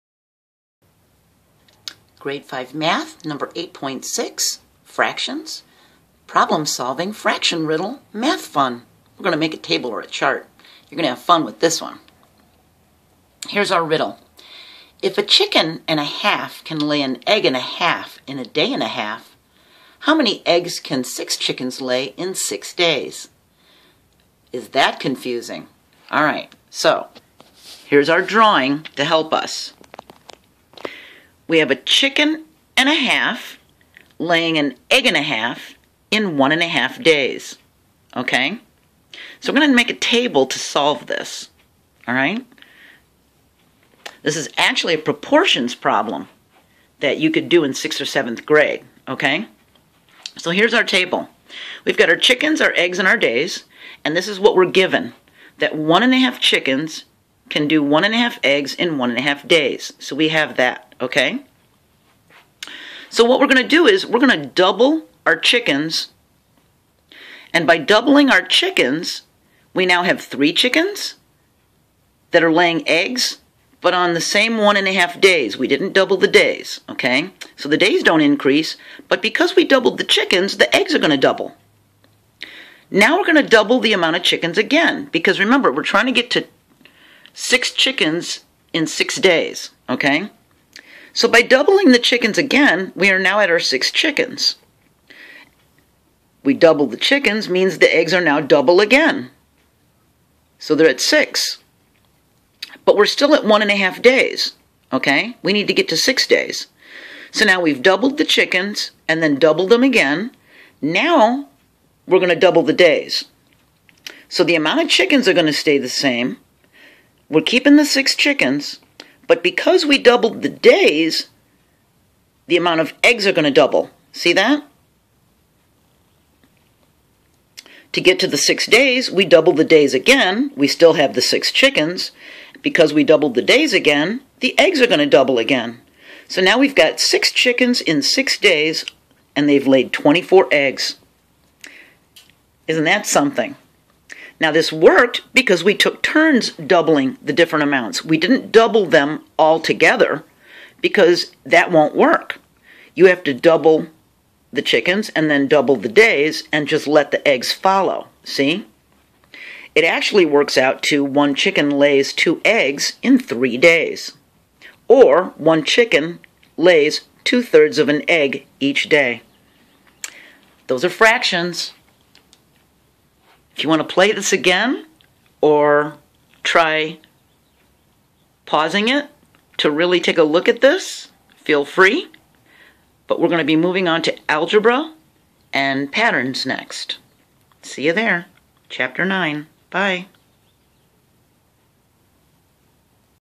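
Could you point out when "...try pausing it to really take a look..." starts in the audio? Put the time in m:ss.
2:56.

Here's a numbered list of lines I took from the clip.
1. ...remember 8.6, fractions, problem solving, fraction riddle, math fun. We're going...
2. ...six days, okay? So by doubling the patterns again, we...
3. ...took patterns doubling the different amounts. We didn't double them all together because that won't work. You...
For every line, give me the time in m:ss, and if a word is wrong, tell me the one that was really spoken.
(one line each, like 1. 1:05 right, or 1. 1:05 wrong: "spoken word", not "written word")
1. 0:03 wrong: "number", not "remember"
2. 1:28 wrong: "chickens", not "patterns"
3. 2:25 wrong: "turns", not "patterns".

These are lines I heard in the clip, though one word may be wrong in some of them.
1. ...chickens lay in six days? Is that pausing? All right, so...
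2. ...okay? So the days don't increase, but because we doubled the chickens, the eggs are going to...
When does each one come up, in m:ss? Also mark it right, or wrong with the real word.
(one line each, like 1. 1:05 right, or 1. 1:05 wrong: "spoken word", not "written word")
1. 0:21 wrong: "confusing", not "pausing"
2. 1:16 right.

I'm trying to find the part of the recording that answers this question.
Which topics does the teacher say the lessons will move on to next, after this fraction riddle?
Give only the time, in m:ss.
3:04.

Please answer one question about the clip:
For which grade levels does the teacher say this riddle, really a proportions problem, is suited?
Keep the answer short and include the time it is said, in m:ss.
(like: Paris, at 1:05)
6th or 7th grade, at 0:47.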